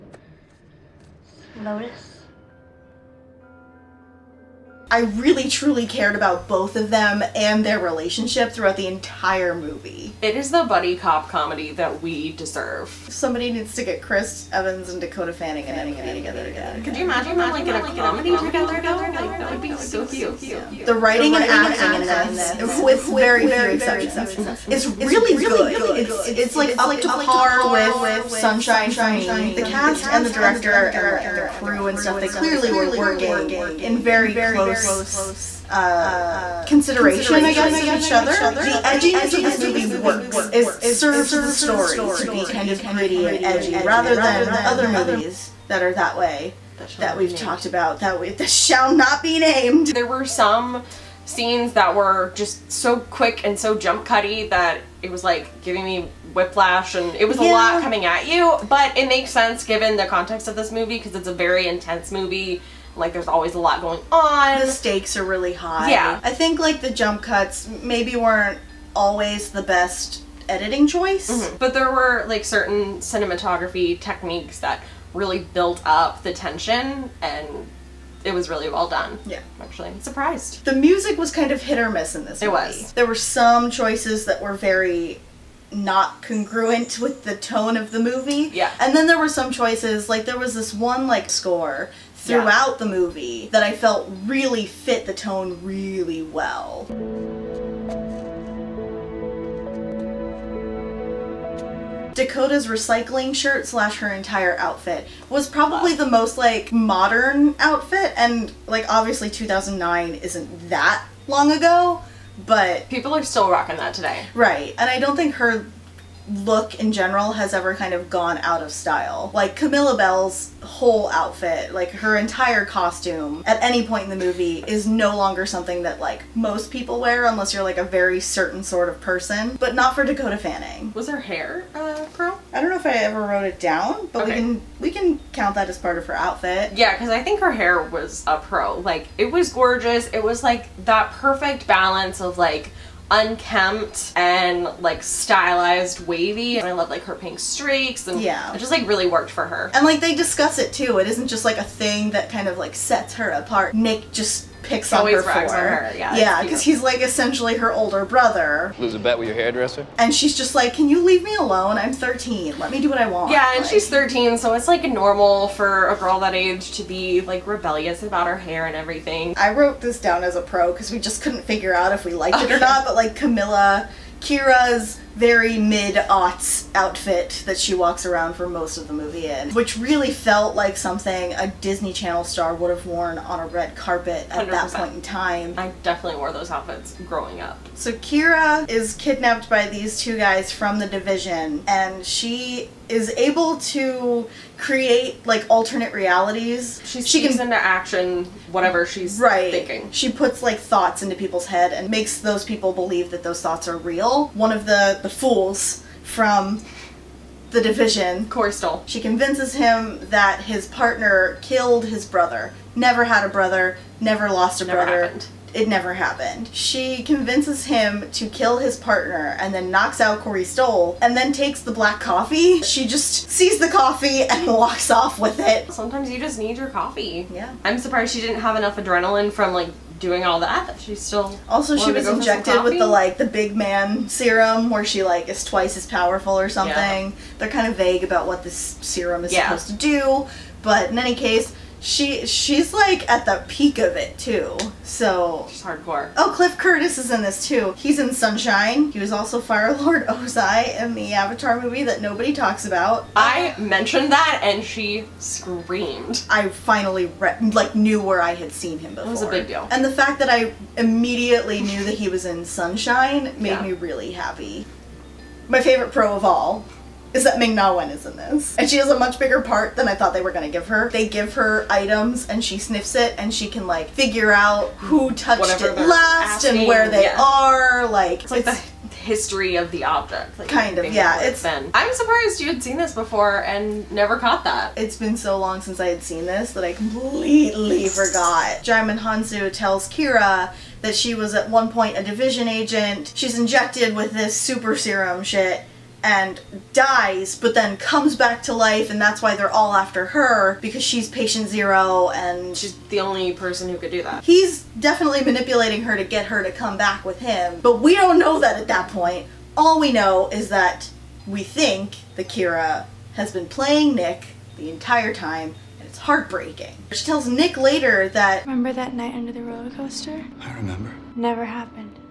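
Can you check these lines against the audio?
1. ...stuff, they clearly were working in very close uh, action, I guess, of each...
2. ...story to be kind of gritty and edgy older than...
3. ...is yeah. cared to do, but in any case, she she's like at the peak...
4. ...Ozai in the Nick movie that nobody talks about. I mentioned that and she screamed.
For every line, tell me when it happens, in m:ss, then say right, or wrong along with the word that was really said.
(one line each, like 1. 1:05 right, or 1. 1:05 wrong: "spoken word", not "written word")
1. 0:31 wrong: "consideration", not "action"
2. 0:41 wrong: "rather", not "older"
3. 3:59 wrong: "supposed", not "cared"
4. 4:10 wrong: "Avatar", not "Nick".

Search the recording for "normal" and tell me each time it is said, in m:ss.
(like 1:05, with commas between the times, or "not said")
2:44.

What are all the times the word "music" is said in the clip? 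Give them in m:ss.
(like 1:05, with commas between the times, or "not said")
1:20.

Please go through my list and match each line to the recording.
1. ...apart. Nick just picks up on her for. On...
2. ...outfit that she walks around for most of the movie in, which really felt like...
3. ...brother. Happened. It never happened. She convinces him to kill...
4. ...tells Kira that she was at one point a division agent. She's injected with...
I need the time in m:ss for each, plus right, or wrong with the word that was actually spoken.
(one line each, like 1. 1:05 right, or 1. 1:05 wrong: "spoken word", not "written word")
1. 2:33 right
2. 2:56 right
3. 3:34 right
4. 4:49 right.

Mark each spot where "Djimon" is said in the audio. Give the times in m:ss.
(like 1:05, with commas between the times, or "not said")
4:48.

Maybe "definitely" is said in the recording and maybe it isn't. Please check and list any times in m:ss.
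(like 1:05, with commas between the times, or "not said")
3:05, 5:04.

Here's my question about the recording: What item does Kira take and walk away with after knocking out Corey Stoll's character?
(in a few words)
Black coffee.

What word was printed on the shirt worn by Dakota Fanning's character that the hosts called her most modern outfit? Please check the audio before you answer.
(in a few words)
Recycling.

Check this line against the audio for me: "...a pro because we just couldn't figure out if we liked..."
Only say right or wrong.
right.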